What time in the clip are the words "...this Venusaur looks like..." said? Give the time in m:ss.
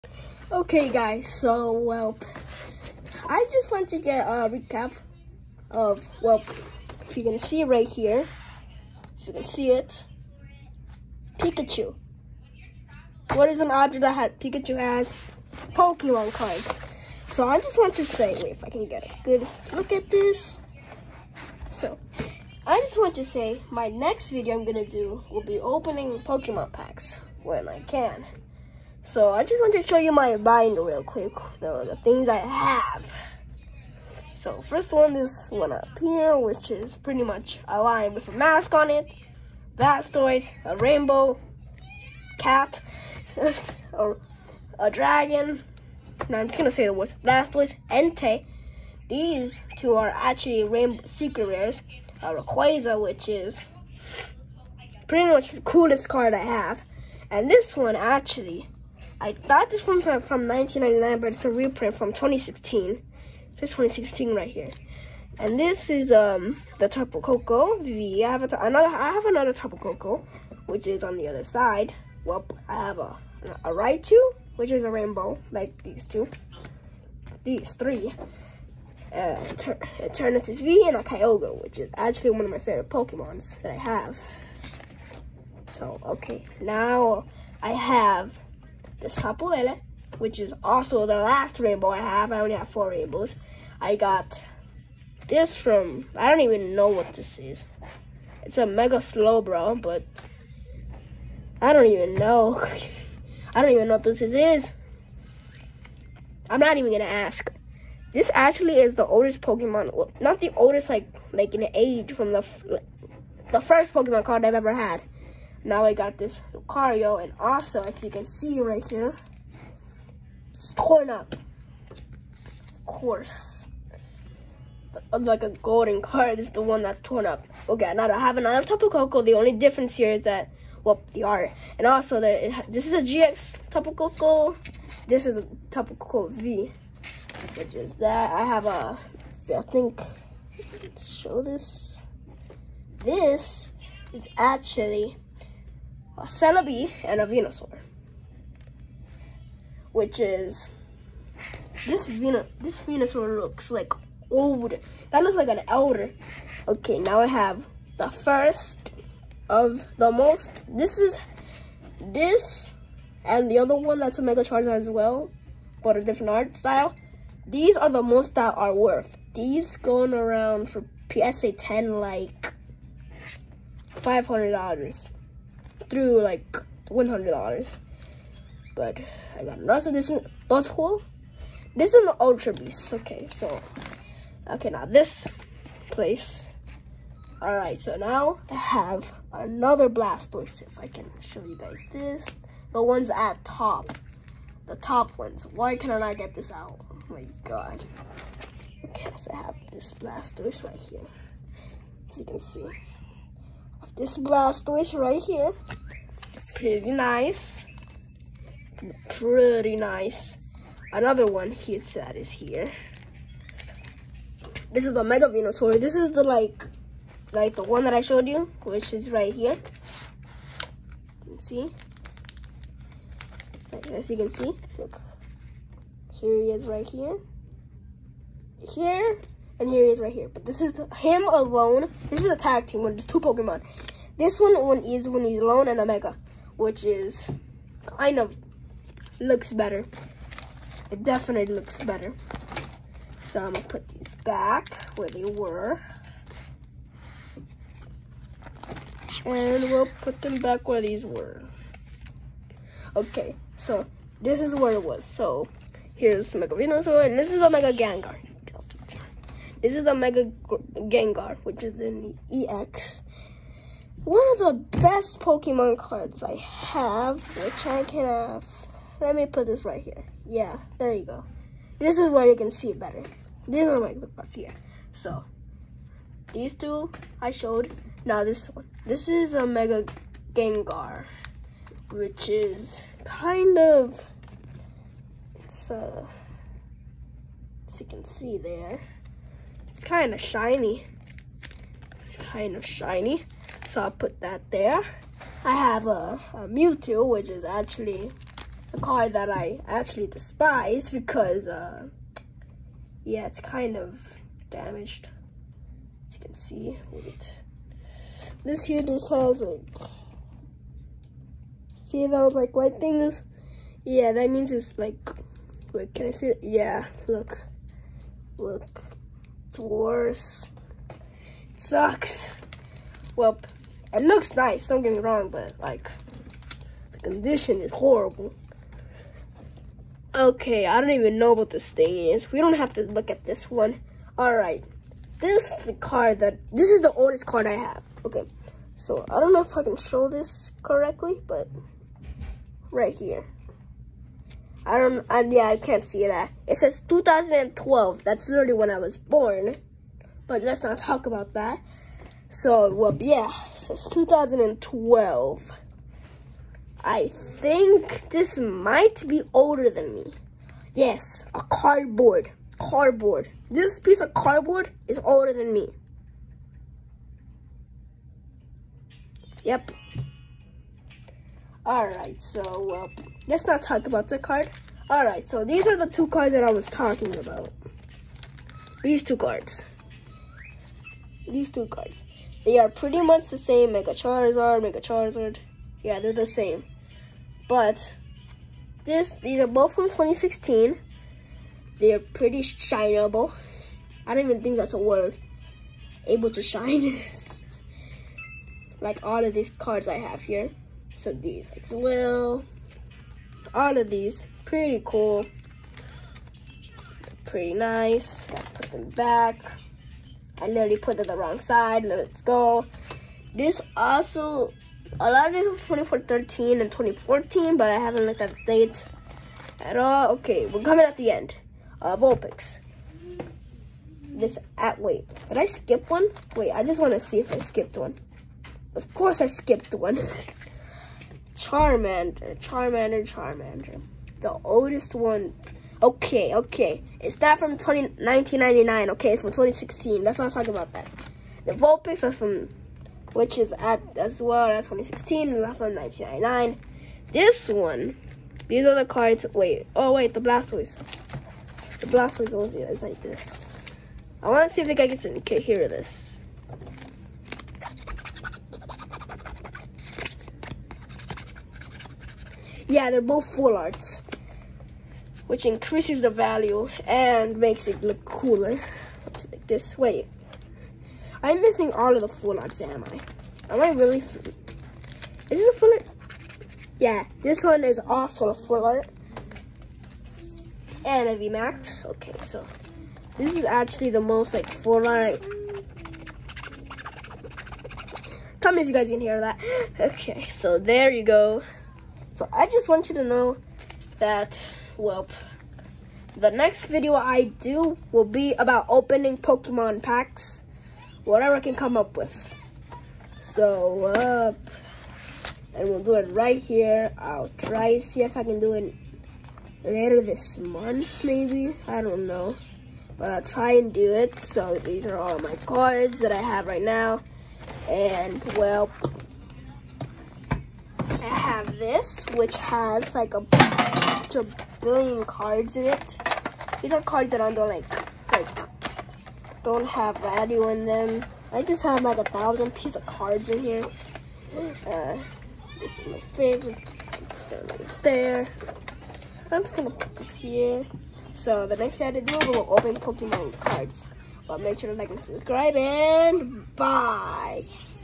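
2:32.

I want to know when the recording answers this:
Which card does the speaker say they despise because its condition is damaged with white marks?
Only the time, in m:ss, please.
4:56.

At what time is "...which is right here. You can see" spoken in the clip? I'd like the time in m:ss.
3:38.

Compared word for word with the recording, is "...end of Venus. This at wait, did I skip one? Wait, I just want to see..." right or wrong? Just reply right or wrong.
wrong.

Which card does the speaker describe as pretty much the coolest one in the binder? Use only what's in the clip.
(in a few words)
Rayquaza.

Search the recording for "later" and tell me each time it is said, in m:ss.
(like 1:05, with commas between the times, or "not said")
8:29.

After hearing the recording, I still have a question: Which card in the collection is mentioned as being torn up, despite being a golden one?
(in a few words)
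Lucario.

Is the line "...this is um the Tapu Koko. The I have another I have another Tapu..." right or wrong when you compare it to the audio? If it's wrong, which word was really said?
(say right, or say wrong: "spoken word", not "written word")
right.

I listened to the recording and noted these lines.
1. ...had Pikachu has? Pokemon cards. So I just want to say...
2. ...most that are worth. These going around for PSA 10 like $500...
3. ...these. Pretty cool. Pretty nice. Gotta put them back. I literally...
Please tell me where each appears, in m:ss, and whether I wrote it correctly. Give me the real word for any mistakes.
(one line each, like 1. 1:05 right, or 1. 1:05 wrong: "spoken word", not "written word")
1. 0:14 right
2. 2:48 right
3. 6:43 right.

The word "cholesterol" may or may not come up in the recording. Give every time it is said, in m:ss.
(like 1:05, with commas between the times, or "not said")
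not said.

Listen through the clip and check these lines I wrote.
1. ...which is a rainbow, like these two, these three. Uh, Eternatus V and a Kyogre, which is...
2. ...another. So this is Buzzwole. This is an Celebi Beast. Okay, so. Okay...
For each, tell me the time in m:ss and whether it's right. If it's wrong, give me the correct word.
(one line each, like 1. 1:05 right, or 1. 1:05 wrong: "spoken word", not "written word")
1. 1:14 right
2. 2:59 wrong: "Ultra", not "Celebi".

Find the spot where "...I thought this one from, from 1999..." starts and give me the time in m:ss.
0:59.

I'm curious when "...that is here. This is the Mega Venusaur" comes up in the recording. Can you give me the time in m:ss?
3:31.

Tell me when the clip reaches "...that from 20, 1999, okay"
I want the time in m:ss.
7:17.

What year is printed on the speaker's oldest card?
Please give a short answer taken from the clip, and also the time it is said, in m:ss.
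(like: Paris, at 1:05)
2012, at 5:46.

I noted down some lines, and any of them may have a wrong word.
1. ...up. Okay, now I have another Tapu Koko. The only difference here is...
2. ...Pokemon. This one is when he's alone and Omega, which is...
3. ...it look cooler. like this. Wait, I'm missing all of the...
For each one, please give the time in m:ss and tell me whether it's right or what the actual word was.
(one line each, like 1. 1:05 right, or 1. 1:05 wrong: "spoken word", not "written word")
1. 2:07 right
2. 3:53 right
3. 7:47 right.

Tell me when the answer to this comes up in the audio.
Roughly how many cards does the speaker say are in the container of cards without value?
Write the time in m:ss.
8:51.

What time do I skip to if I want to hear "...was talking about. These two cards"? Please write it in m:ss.
6:16.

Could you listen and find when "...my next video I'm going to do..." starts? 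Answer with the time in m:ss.
0:23.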